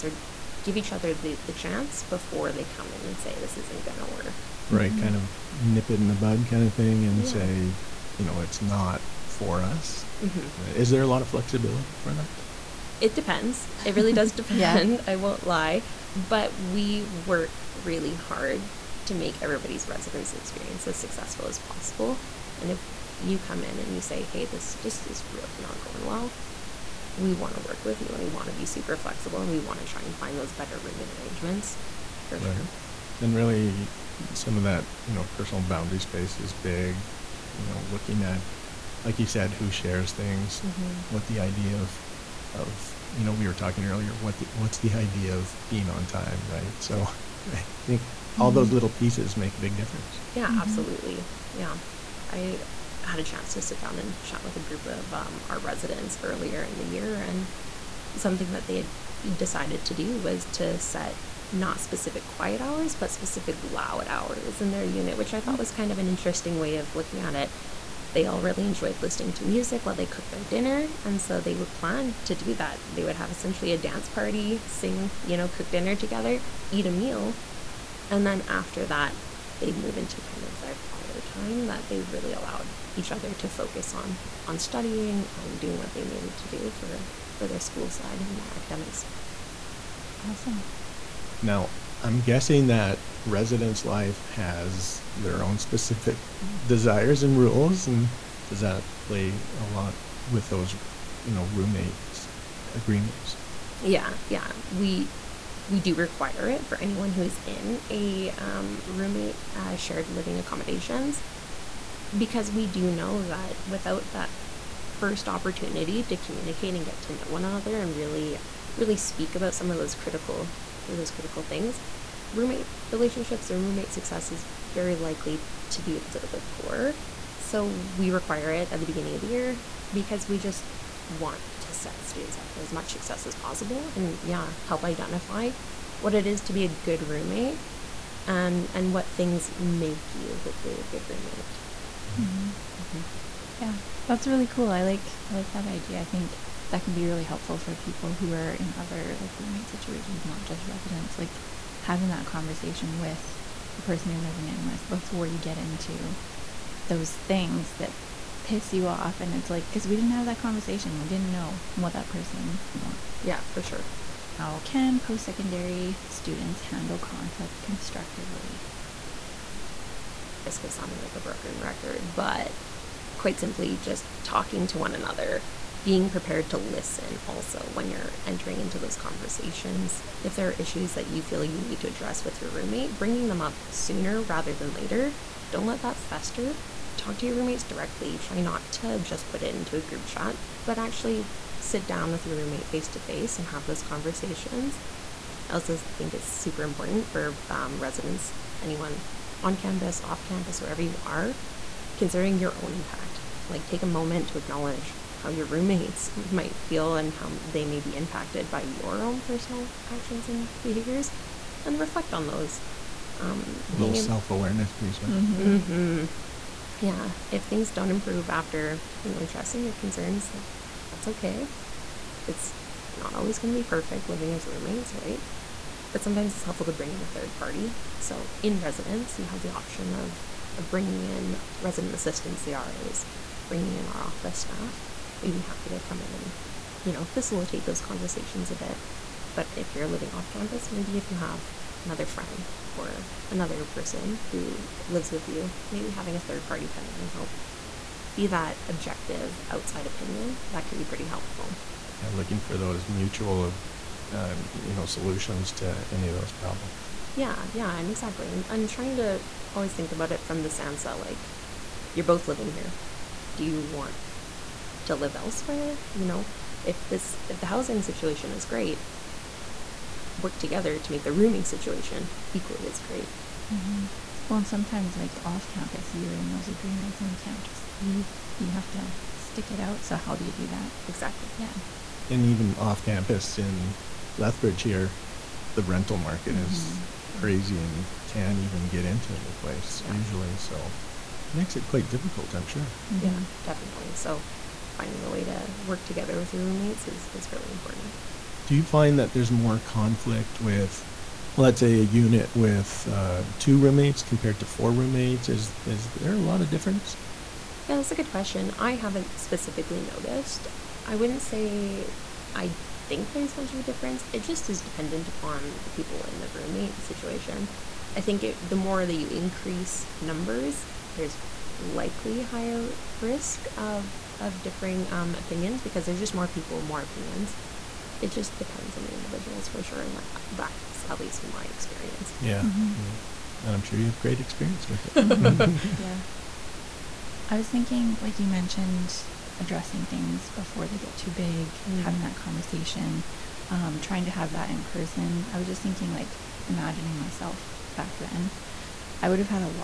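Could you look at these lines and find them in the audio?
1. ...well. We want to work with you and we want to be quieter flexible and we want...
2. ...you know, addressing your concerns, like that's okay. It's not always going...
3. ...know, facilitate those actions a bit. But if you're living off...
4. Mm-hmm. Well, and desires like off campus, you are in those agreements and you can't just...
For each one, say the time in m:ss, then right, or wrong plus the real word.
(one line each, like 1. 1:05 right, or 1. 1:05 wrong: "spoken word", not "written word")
1. 0:26 wrong: "super", not "quieter"
2. 3:39 right
3. 3:56 wrong: "conversations", not "actions"
4. 4:33 wrong: "sometimes", not "desires".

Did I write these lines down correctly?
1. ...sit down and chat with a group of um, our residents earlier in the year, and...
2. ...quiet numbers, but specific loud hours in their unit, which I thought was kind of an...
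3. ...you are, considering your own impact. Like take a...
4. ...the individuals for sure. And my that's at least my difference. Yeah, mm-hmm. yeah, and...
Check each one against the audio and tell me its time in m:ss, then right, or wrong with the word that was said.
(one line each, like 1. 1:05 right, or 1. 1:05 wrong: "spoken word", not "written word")
1. 0:53 right
2. 1:02 wrong: "hours", not "numbers"
3. 3:20 right
4. 5:28 wrong: "experience", not "difference".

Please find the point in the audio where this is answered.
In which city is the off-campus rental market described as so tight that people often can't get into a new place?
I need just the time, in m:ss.
4:44.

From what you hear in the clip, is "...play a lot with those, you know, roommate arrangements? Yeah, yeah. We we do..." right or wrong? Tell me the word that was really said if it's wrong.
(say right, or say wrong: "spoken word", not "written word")
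wrong: "agreements", not "arrangements".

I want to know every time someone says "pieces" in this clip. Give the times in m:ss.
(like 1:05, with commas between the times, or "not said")
0:48, 3:34.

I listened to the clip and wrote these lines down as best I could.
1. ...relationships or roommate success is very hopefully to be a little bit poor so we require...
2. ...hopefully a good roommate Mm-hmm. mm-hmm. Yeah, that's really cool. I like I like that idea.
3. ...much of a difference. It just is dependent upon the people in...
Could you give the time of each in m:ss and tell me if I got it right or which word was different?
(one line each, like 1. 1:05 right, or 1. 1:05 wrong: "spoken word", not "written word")
1. 2:02 wrong: "likely", not "hopefully"
2. 2:20 right
3. 5:13 right.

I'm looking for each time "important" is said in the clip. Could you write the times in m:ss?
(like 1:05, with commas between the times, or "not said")
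3:16, 4:57.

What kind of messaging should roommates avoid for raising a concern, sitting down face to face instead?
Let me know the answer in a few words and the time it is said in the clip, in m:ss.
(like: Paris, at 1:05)
group chat, at 3:09.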